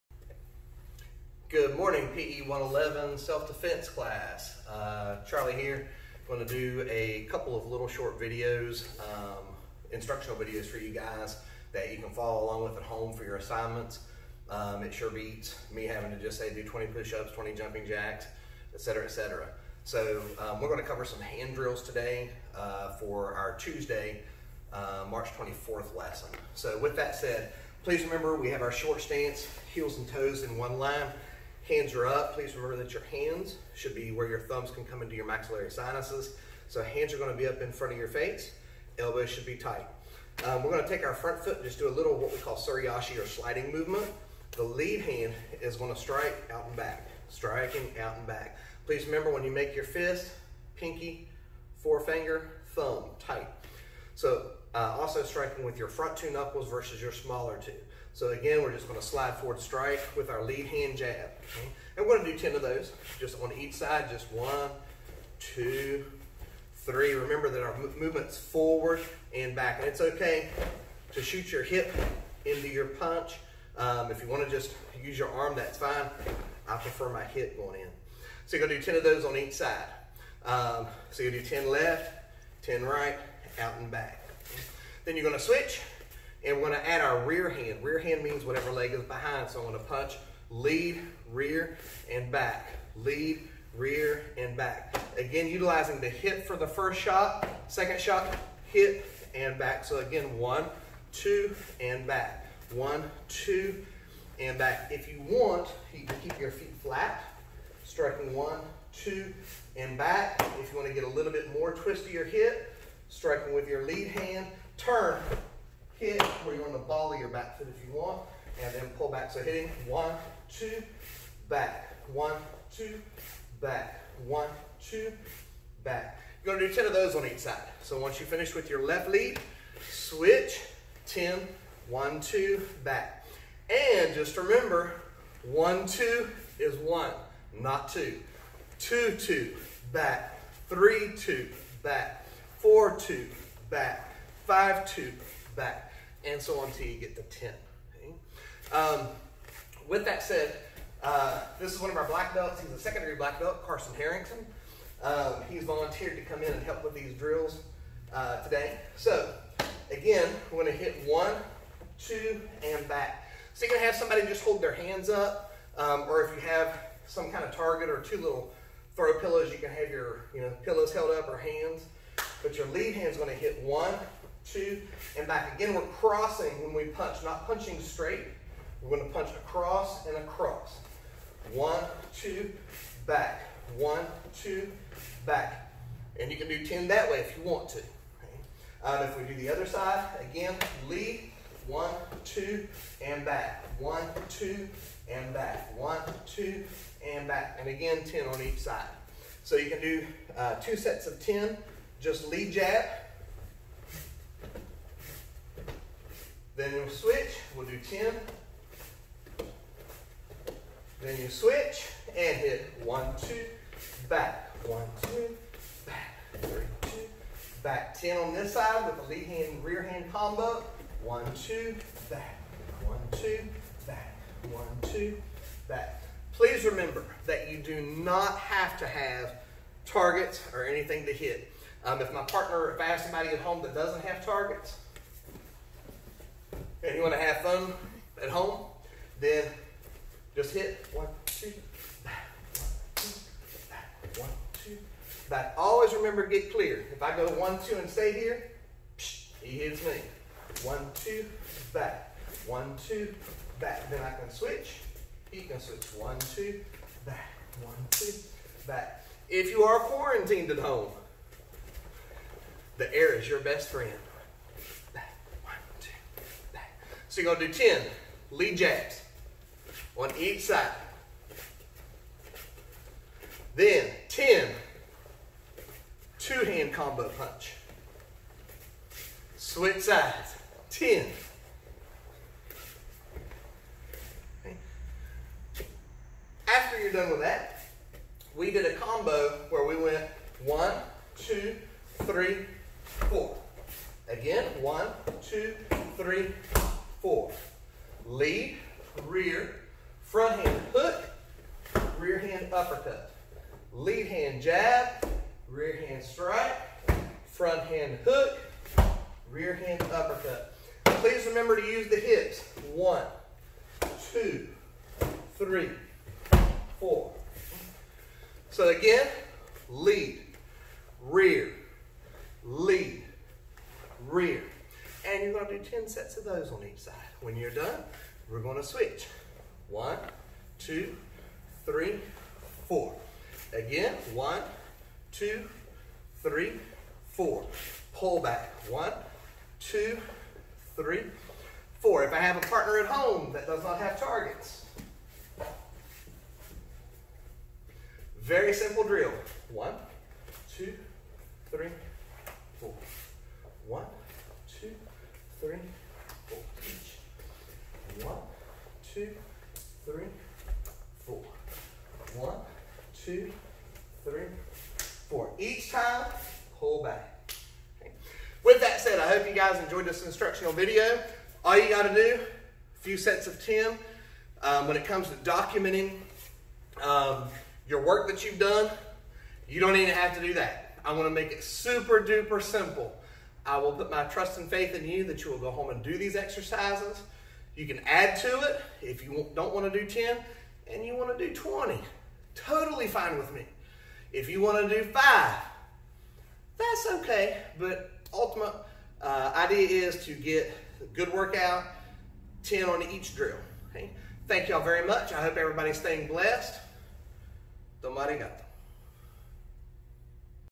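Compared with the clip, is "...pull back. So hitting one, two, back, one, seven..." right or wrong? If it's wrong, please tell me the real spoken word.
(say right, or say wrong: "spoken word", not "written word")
wrong: "two", not "seven".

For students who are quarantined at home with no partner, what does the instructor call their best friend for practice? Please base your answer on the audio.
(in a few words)
the air.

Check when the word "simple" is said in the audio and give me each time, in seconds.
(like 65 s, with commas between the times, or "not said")
348 s, 382 s.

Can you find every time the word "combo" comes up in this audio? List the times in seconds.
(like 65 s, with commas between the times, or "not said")
220 s, 276 s, 288 s.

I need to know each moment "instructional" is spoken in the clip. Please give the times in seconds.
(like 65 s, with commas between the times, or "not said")
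9 s, 370 s.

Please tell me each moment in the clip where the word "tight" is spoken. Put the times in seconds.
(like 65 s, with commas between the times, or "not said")
39 s, 53 s.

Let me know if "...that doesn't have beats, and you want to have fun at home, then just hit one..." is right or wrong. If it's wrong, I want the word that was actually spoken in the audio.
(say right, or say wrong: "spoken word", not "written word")
wrong: "targets", not "beats".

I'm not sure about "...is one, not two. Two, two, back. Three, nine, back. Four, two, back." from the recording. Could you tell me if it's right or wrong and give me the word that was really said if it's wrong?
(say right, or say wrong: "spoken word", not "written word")
wrong: "two", not "nine".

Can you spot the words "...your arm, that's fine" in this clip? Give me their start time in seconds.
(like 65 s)
75 s.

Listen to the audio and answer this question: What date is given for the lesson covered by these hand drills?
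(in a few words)
March 24th.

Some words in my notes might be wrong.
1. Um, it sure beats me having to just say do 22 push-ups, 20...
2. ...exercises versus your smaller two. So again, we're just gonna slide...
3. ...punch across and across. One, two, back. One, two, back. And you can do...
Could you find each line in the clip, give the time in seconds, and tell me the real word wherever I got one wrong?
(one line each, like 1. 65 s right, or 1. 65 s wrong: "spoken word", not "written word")
1. 14 s wrong: "20", not "22"
2. 56 s wrong: "knuckles", not "exercises"
3. 179 s right.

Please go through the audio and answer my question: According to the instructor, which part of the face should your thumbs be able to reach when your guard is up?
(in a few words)
maxillary sinuses.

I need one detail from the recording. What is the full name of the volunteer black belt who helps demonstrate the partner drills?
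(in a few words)
Carson Harrington.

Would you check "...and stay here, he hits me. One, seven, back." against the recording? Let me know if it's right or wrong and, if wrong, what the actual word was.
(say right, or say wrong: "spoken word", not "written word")
wrong: "two", not "seven".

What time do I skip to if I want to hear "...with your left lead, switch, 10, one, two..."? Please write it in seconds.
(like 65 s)
128 s.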